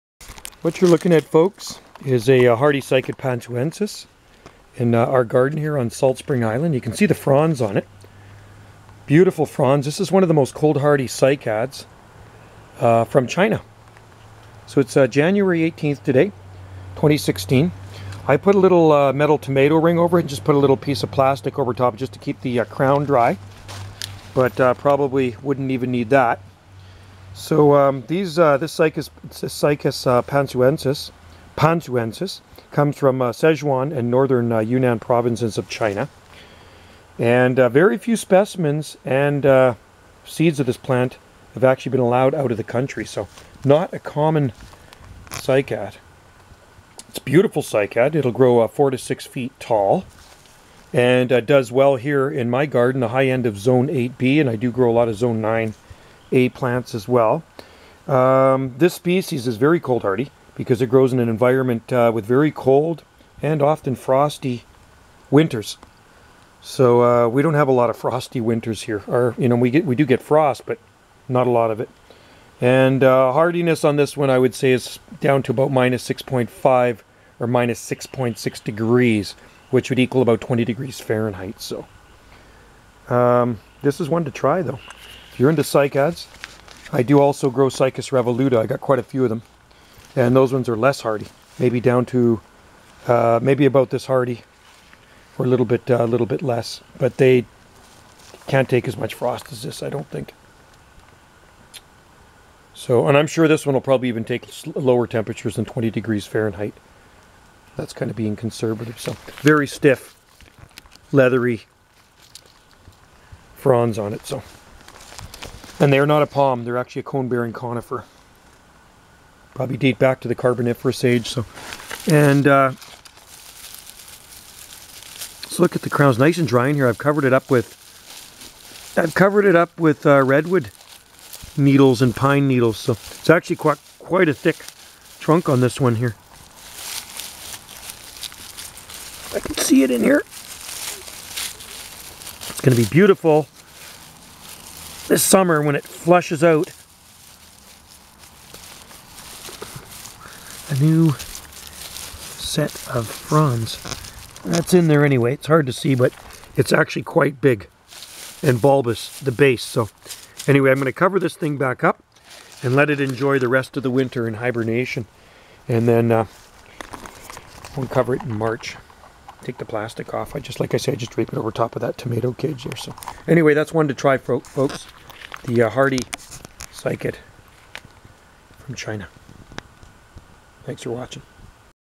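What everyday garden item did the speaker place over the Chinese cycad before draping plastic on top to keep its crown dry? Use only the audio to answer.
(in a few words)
metal tomato ring.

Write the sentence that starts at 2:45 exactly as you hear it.
And then uh, we'll cover it in March.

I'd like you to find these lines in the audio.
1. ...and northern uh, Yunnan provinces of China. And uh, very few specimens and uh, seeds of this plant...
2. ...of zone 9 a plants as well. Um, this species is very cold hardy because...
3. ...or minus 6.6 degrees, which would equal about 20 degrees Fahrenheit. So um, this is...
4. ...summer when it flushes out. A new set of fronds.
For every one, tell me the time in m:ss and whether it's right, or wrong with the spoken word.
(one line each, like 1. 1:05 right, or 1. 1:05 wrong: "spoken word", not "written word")
1. 0:33 right
2. 0:55 right
3. 1:17 right
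4. 2:25 right.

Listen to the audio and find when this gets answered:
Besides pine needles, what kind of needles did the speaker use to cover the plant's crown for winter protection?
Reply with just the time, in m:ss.
2:10.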